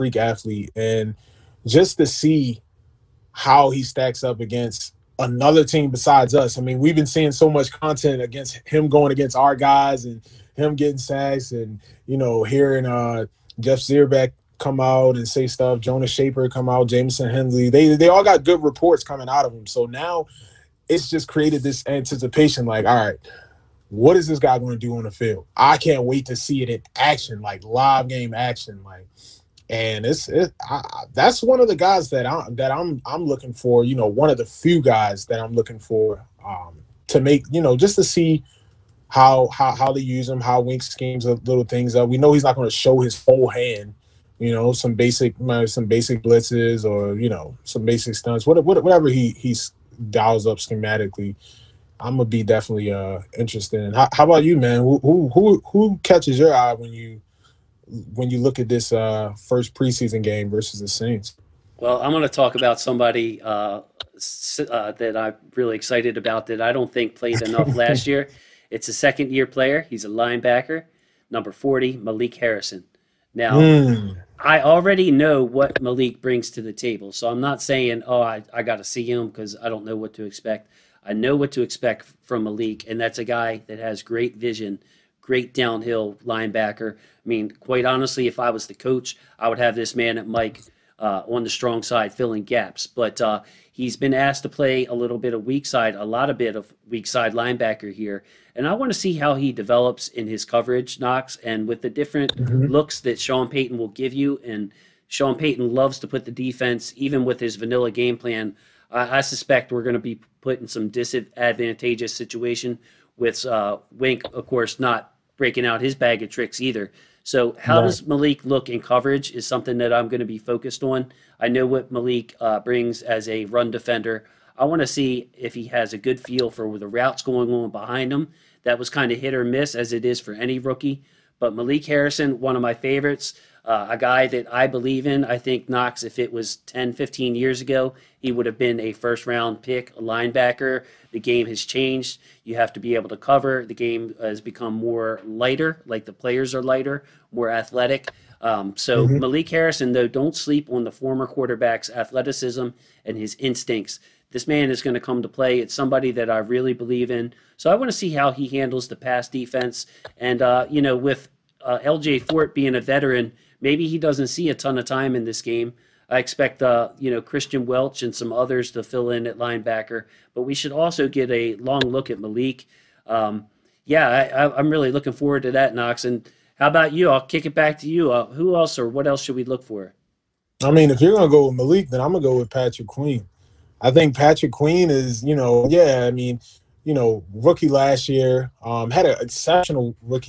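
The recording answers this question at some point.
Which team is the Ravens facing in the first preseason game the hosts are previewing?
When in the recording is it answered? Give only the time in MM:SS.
01:00.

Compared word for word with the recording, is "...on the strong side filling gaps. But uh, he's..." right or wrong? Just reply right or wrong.
right.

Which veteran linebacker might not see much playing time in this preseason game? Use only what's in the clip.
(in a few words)
LJ Fort.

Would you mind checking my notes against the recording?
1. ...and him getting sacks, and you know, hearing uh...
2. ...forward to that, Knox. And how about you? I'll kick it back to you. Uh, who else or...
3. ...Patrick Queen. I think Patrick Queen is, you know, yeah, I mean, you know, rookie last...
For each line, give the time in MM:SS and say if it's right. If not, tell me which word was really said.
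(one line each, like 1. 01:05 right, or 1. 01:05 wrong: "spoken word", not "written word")
1. 00:10 right
2. 02:55 right
3. 03:02 right.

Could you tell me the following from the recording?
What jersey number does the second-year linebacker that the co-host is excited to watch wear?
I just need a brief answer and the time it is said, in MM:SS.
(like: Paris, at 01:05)
40, at 01:11.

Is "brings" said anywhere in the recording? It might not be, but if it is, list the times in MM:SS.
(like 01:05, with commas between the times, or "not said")
01:16, 02:02.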